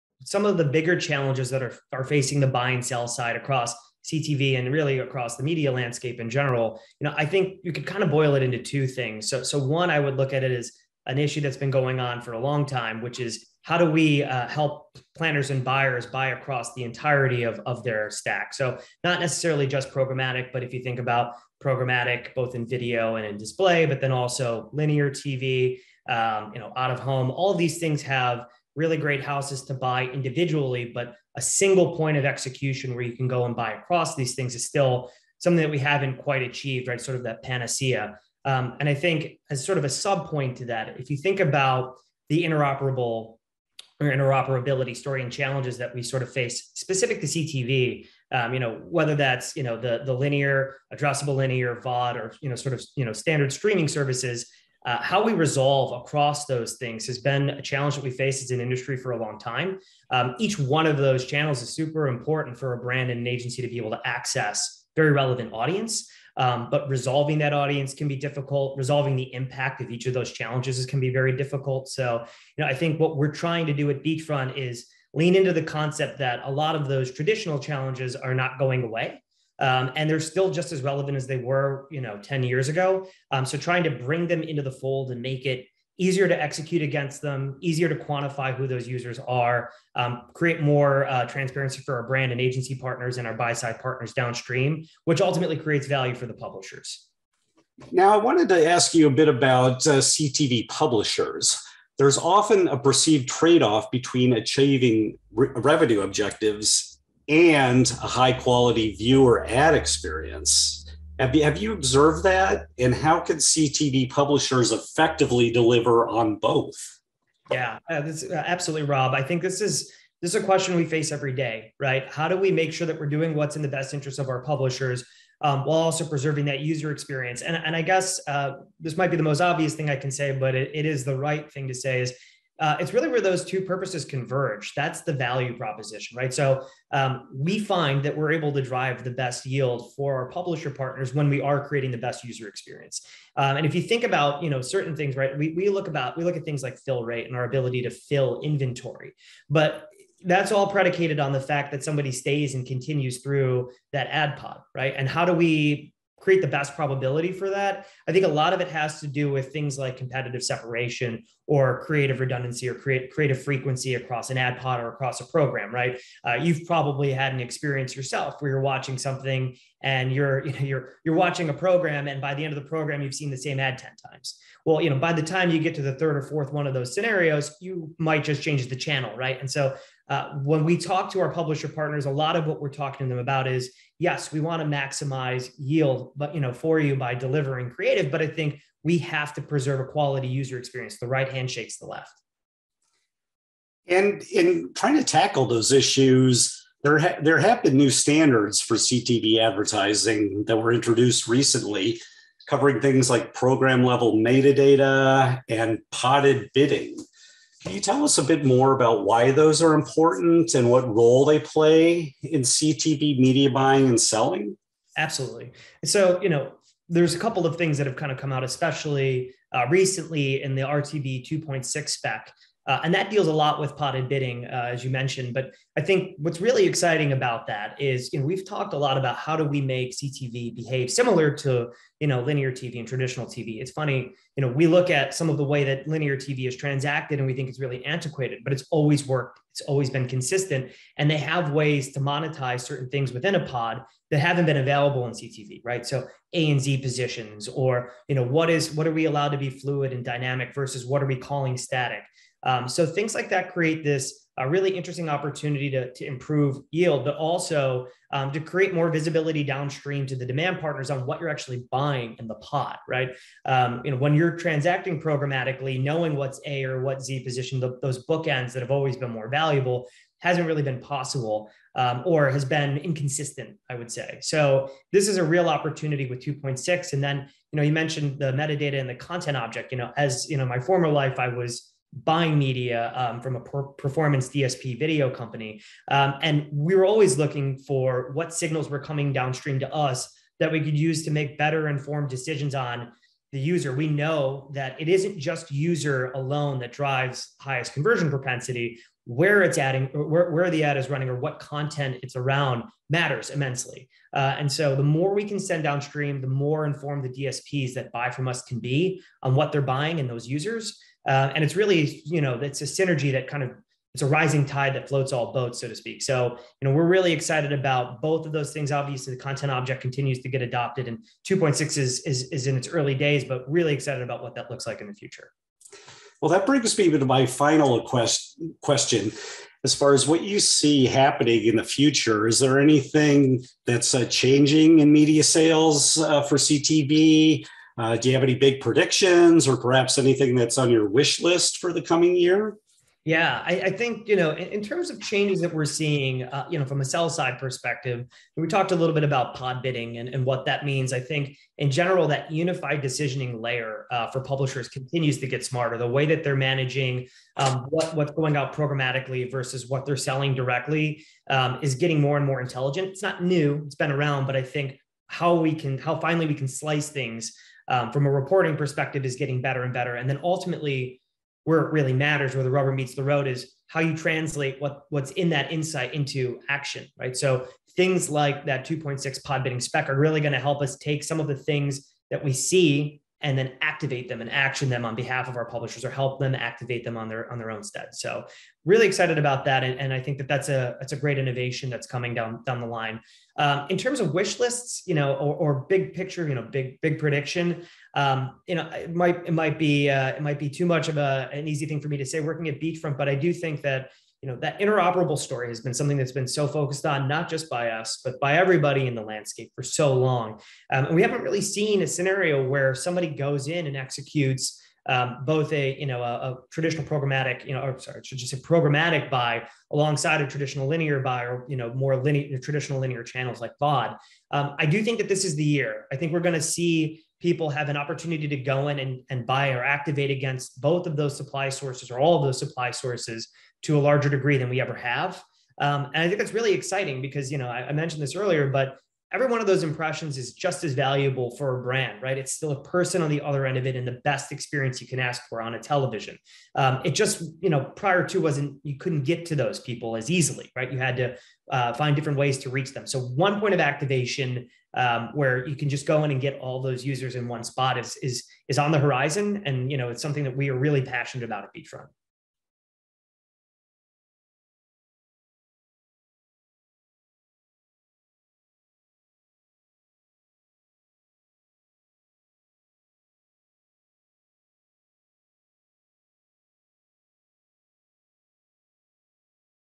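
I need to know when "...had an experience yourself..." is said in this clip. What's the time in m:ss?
2:47.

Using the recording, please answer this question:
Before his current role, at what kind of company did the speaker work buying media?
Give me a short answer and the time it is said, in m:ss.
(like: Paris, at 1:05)
performance DSP video company, at 4:43.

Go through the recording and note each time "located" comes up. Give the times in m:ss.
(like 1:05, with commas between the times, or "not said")
not said.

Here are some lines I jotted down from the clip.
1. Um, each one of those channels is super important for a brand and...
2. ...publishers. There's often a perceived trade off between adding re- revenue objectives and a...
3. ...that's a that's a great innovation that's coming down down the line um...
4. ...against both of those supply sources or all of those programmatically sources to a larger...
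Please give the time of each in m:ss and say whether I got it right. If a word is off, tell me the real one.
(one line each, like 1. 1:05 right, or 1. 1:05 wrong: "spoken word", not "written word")
1. 1:00 right
2. 1:40 wrong: "achieving", not "adding"
3. 6:30 right
4. 7:10 wrong: "supply", not "programmatically".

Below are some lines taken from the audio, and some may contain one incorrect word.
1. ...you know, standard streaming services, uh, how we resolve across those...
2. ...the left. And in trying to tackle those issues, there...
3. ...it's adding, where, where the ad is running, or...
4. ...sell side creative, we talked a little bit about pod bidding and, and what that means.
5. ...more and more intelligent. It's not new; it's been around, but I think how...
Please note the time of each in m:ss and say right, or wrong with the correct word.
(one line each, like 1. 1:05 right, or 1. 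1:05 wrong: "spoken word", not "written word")
1. 0:52 right
2. 3:11 right
3. 4:59 right
4. 5:46 wrong: "perspective", not "creative"
5. 6:01 right.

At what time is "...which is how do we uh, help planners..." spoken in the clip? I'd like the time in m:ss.
0:13.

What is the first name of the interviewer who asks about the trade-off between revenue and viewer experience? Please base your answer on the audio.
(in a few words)
Rob.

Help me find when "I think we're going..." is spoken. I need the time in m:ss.
7:05.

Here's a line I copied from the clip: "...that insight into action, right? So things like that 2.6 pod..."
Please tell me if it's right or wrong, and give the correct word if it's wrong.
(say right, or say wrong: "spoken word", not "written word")
right.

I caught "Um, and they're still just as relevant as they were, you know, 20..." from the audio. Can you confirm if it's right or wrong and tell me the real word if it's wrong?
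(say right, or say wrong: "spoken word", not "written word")
wrong: "10", not "20".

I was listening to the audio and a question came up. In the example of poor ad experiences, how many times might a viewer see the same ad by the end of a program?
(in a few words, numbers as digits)
10.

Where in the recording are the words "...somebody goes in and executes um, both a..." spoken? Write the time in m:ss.
6:52.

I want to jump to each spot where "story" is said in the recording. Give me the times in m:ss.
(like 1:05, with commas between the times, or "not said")
0:44, 6:45.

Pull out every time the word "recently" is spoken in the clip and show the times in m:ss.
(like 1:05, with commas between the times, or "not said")
3:21, 3:39.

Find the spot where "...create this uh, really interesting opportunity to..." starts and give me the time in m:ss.
4:13.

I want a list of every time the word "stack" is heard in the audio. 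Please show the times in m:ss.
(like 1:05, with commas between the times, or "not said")
0:18.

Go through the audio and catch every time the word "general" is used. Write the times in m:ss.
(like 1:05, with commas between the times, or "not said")
0:06, 5:51.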